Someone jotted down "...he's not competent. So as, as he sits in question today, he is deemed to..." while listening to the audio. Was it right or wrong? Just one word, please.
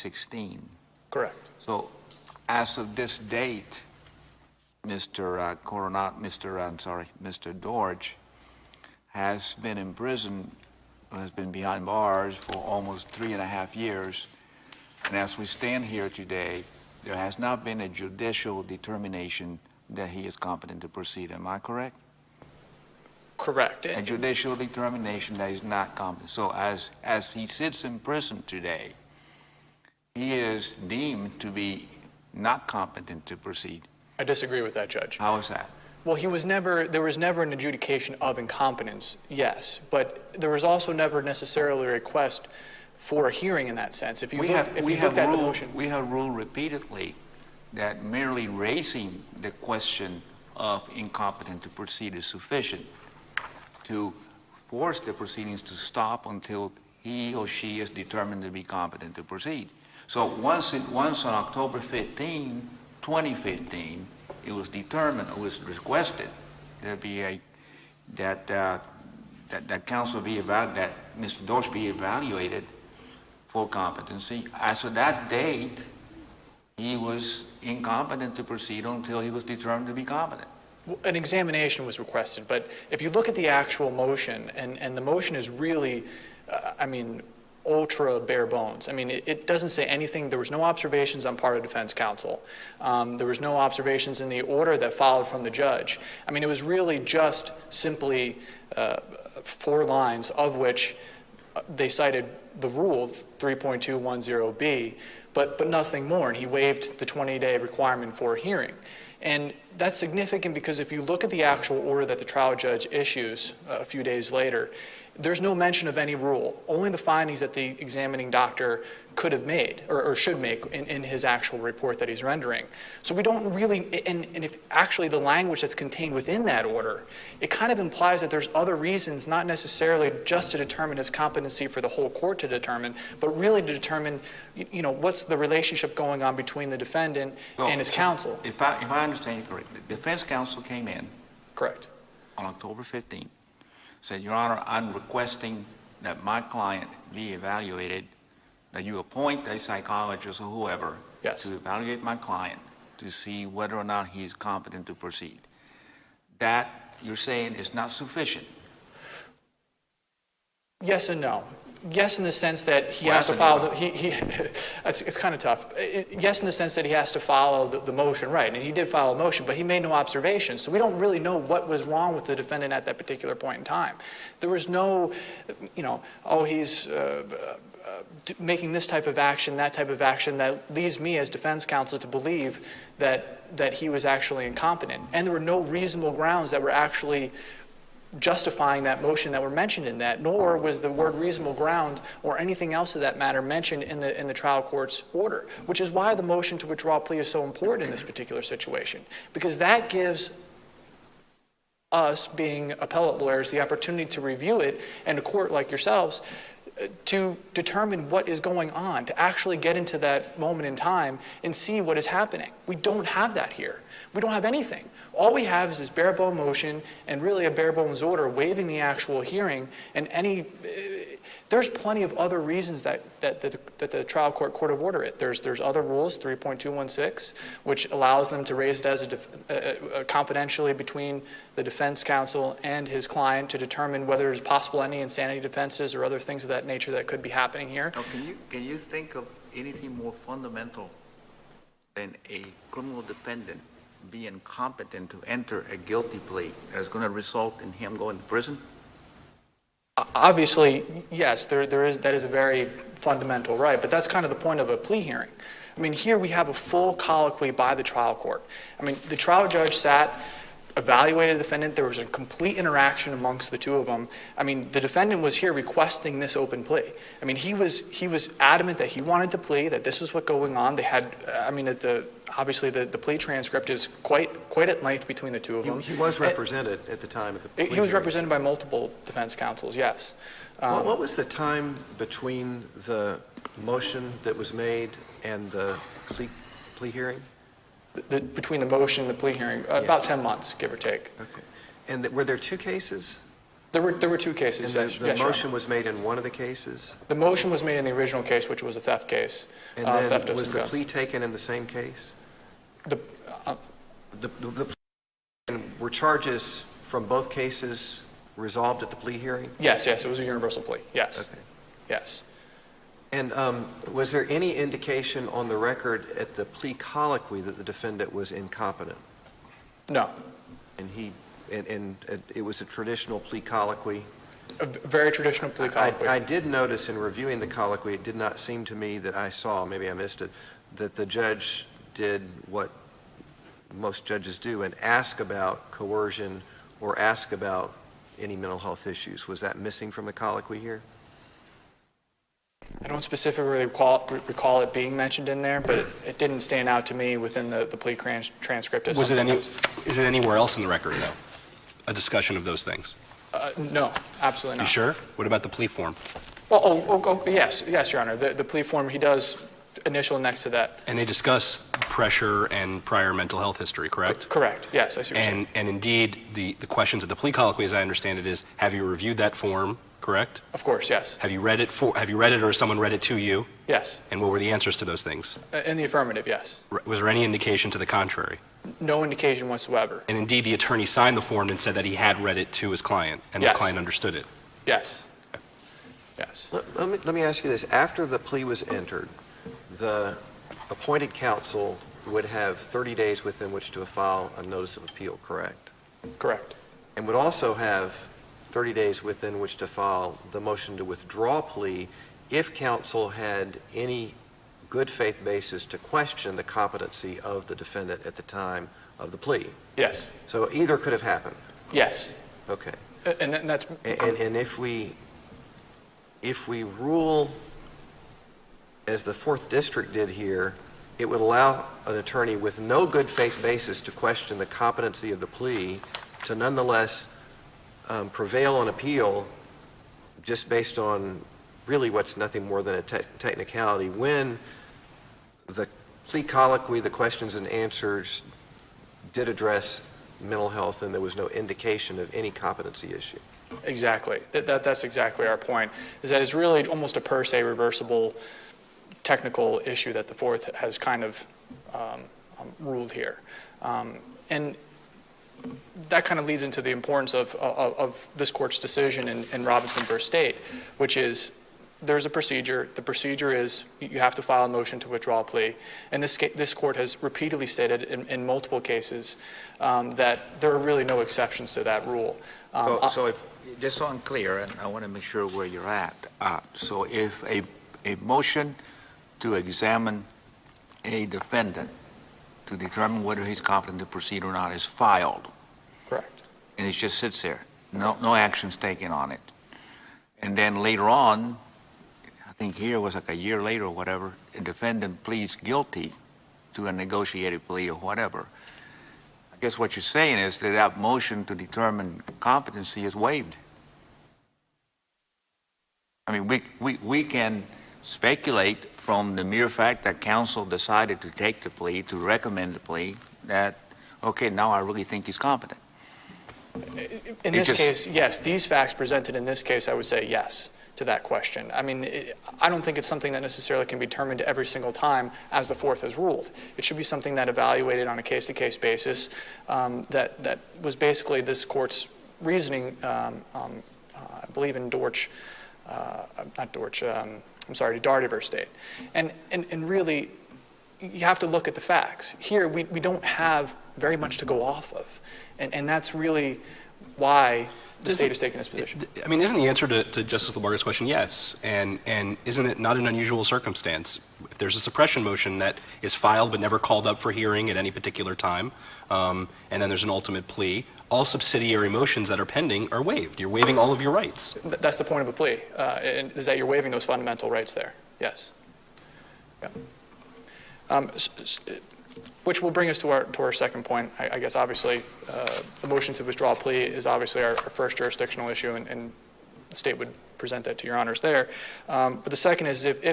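wrong.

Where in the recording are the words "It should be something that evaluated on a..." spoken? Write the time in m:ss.
8:46.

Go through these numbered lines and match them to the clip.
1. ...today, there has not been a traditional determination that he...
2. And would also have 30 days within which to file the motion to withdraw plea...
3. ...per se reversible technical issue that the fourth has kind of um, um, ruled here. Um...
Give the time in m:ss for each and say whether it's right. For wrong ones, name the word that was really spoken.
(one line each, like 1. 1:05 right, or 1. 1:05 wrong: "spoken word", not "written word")
1. 0:16 wrong: "judicial", not "traditional"
2. 6:36 right
3. 7:27 right.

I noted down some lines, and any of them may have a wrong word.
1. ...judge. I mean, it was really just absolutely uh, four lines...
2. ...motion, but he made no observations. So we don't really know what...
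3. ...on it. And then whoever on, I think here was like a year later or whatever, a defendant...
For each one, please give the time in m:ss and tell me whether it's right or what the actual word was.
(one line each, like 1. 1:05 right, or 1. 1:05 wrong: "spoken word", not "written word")
1. 1:35 wrong: "simply", not "absolutely"
2. 2:49 right
3. 8:08 wrong: "later", not "whoever".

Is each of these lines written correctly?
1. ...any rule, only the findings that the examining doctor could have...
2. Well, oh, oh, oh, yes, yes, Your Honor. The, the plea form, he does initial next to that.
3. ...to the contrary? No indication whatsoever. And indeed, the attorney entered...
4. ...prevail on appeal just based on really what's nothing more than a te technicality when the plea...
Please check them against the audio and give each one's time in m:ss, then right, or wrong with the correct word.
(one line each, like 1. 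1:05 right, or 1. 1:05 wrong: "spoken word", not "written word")
1. 1:55 right
2. 5:56 right
3. 6:17 wrong: "signed", not "entered"
4. 7:08 right.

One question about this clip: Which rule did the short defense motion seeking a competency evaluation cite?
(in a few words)
3.210b.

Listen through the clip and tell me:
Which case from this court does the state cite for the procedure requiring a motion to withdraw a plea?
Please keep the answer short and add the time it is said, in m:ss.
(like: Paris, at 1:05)
Robinson v. State, at 7:39.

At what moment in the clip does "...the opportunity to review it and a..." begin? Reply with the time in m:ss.
3:23.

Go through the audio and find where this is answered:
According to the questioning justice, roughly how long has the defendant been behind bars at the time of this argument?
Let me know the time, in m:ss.
0:12.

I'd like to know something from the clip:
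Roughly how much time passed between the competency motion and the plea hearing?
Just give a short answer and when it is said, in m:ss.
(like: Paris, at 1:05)
about 10 months, at 4:49.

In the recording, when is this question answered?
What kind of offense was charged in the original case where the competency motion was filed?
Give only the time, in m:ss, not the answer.
4:58.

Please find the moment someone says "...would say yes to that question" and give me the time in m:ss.
8:39.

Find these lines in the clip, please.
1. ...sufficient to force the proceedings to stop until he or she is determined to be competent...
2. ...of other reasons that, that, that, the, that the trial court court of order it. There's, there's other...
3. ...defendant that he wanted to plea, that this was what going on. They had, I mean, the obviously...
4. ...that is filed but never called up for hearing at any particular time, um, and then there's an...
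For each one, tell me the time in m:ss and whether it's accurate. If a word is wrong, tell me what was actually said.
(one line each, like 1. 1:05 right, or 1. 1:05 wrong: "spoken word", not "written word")
1. 0:52 right
2. 3:42 right
3. 4:28 wrong: "adamant", not "defendant"
4. 9:15 right.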